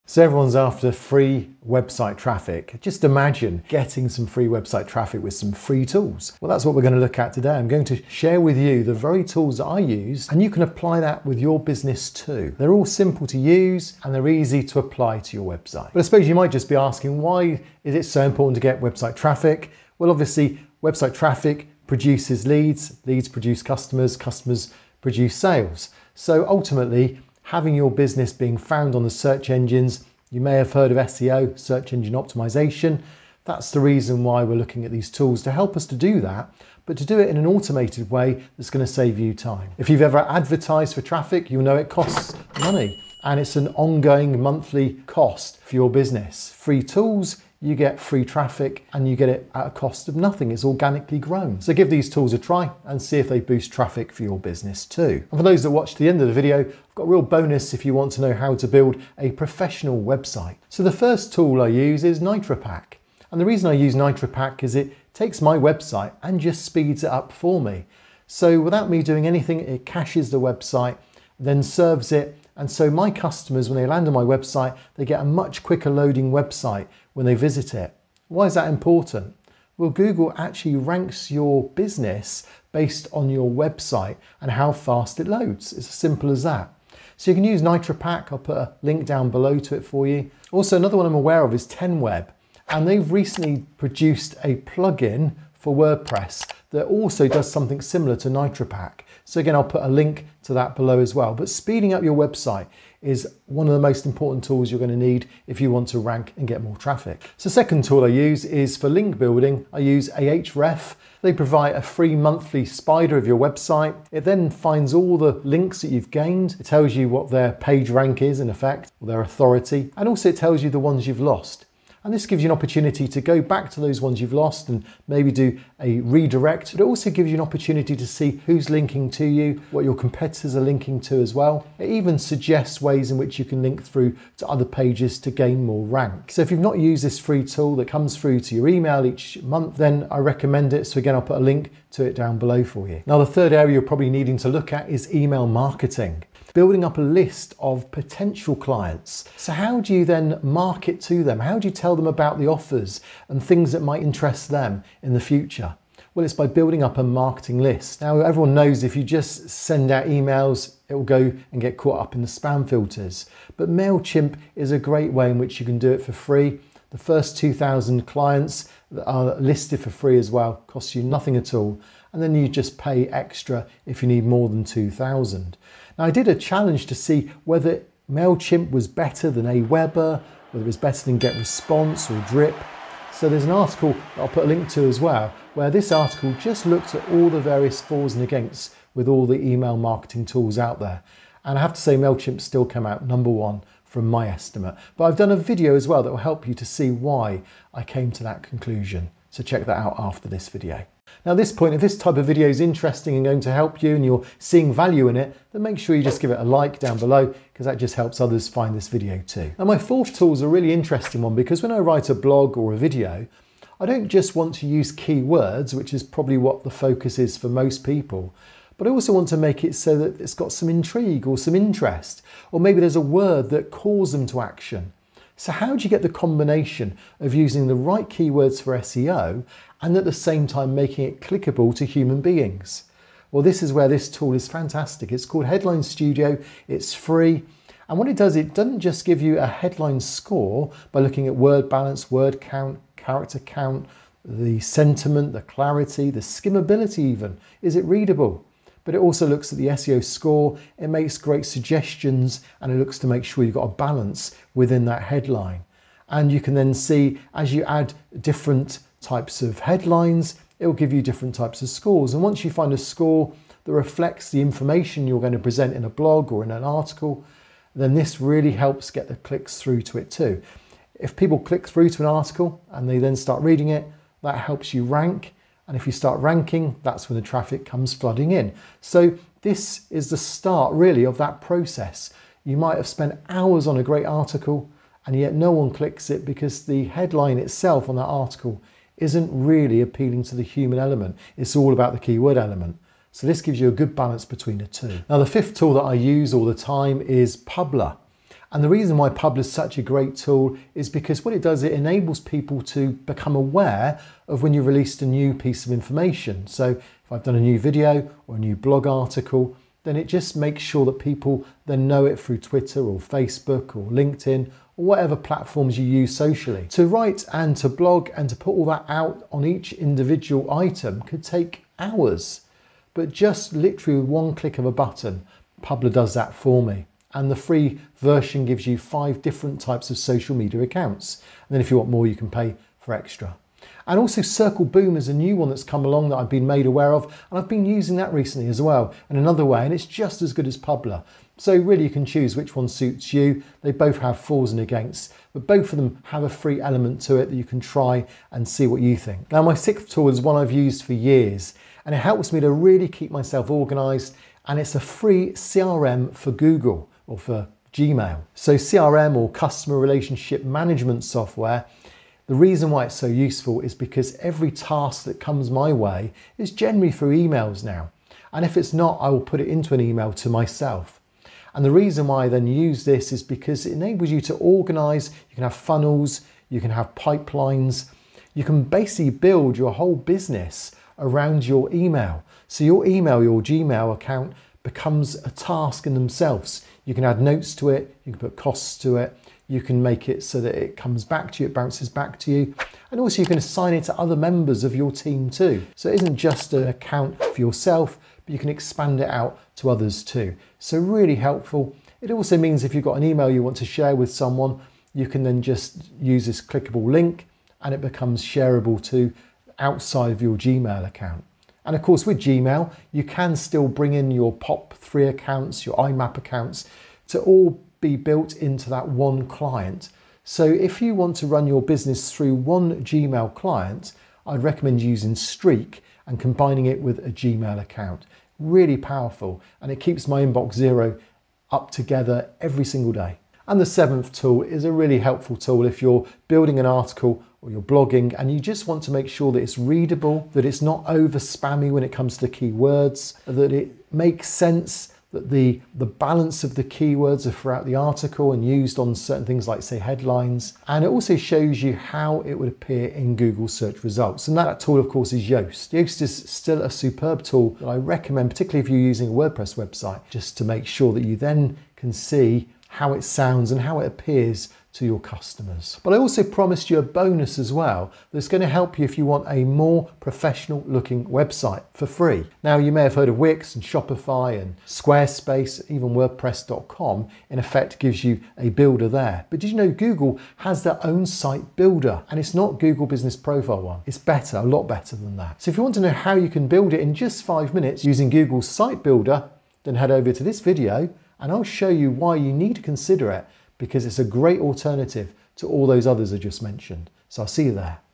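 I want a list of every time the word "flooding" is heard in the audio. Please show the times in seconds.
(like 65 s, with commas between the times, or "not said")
277 s.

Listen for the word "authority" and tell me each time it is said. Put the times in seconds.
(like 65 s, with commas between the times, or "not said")
119 s.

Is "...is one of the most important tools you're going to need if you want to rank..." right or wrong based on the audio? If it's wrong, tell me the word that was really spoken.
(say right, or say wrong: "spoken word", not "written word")
right.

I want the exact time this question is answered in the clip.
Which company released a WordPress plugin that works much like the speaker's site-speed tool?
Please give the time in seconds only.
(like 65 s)
91 s.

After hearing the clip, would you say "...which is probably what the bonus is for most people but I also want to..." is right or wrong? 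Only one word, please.
wrong.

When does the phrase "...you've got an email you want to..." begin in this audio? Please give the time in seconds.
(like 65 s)
402 s.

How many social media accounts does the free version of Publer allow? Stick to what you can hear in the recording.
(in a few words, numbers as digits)
5.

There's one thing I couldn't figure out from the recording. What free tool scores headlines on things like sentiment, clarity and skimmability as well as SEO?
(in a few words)
Headline Studio.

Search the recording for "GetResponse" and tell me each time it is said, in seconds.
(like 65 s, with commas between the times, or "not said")
181 s.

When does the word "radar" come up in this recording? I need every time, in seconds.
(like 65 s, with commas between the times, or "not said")
not said.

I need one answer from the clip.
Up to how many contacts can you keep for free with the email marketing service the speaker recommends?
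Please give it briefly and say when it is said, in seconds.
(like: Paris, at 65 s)
2,000, at 166 s.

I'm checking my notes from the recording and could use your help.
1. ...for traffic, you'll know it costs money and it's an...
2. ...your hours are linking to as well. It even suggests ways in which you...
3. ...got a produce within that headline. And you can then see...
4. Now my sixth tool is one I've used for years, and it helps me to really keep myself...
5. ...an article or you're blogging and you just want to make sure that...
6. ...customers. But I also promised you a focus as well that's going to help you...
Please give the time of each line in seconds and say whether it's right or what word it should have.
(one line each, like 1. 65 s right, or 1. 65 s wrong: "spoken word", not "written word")
1. 40 s right
2. 129 s wrong: "competitors", not "hours"
3. 253 s wrong: "balance", not "produce"
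4. 349 s right
5. 436 s right
6. 464 s wrong: "bonus", not "focus".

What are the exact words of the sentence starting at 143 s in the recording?
Now, the third area you're probably needing to look at is email marketing building up a list of potential clients.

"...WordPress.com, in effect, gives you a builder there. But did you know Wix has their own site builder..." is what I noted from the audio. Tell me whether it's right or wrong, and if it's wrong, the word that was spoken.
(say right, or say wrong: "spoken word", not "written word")
wrong: "Google", not "Wix".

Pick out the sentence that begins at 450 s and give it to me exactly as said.
And it also shows you how it would appear in Google search results.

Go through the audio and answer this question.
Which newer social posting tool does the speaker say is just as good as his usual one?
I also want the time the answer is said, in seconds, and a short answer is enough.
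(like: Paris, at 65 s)
Circle Boom, at 334 s.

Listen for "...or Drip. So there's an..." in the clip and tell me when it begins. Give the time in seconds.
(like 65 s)
182 s.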